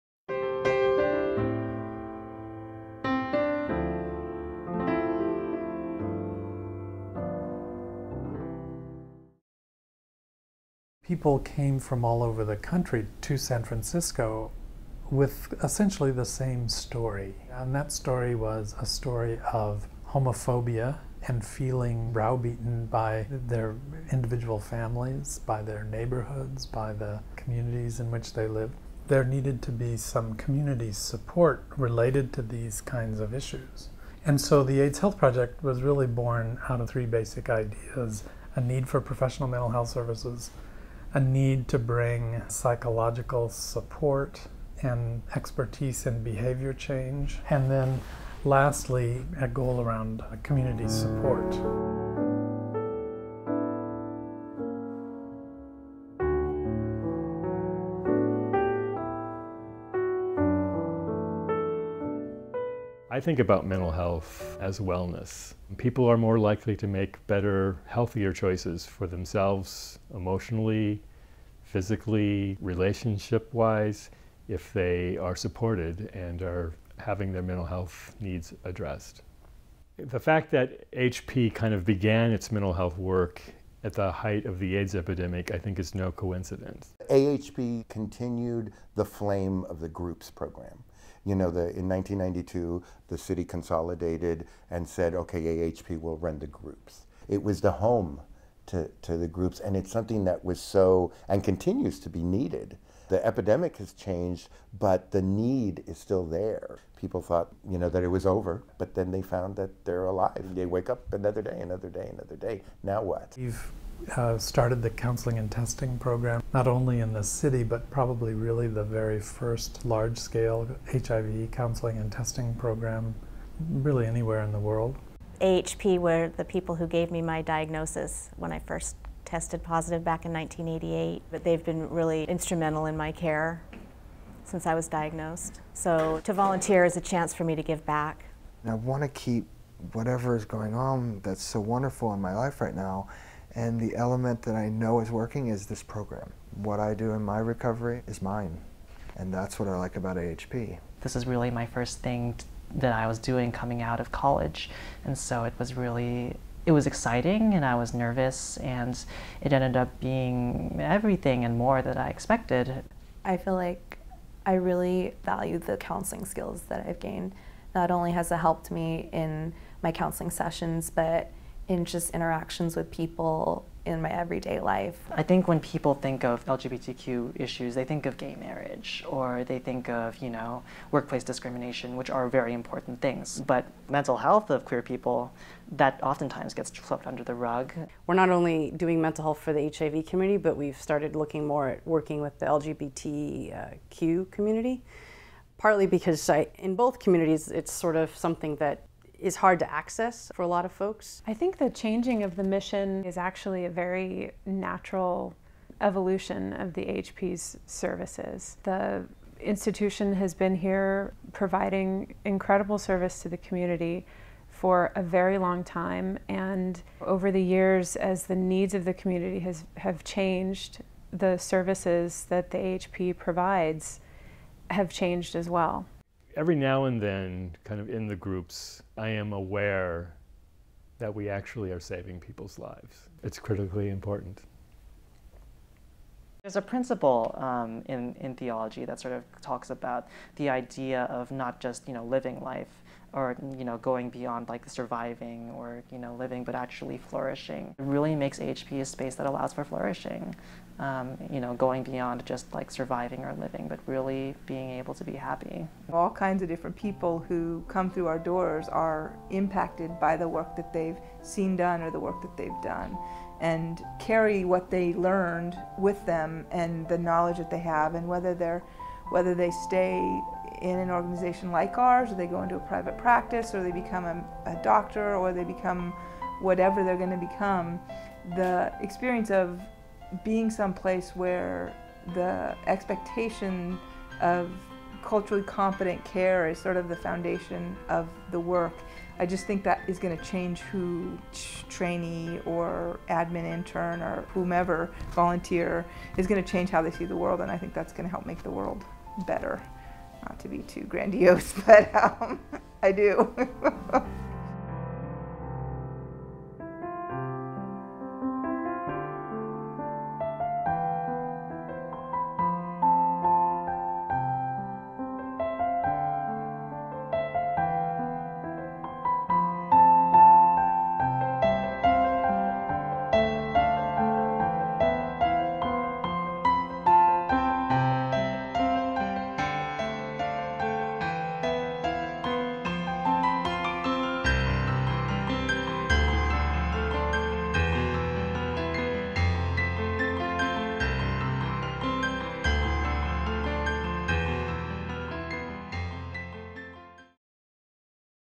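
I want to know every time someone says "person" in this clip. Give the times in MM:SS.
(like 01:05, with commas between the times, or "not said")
not said.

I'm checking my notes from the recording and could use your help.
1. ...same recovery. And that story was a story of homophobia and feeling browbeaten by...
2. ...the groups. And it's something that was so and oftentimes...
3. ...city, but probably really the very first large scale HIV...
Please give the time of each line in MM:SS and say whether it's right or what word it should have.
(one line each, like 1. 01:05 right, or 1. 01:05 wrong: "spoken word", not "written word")
1. 00:16 wrong: "story", not "recovery"
2. 01:39 wrong: "continues", not "oftentimes"
3. 01:57 right.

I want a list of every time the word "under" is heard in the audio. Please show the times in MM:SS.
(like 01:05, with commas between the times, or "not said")
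03:07.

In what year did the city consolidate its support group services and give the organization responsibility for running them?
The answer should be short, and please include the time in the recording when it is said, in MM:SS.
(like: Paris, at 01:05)
1992, at 01:31.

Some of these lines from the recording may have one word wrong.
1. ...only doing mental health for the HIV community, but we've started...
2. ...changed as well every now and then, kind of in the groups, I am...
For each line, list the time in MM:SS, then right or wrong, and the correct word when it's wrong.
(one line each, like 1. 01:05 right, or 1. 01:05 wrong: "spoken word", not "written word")
1. 03:08 right
2. 03:44 right.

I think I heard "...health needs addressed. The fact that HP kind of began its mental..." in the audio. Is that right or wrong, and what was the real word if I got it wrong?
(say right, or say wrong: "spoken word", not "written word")
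right.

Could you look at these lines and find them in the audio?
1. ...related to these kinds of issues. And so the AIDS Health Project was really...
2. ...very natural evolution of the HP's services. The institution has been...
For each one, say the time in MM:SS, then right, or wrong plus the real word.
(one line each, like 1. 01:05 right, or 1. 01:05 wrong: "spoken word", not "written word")
1. 00:31 right
2. 03:23 right.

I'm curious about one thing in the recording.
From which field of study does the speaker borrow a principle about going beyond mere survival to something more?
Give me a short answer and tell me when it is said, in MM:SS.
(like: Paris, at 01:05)
Theology, at 03:58.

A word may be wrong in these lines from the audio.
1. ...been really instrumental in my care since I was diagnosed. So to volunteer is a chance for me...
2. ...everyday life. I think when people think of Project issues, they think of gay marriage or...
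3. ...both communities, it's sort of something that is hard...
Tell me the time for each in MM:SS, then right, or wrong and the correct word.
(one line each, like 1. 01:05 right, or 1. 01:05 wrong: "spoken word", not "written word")
1. 02:11 right
2. 02:54 wrong: "LGBTQ", not "Project"
3. 03:16 right.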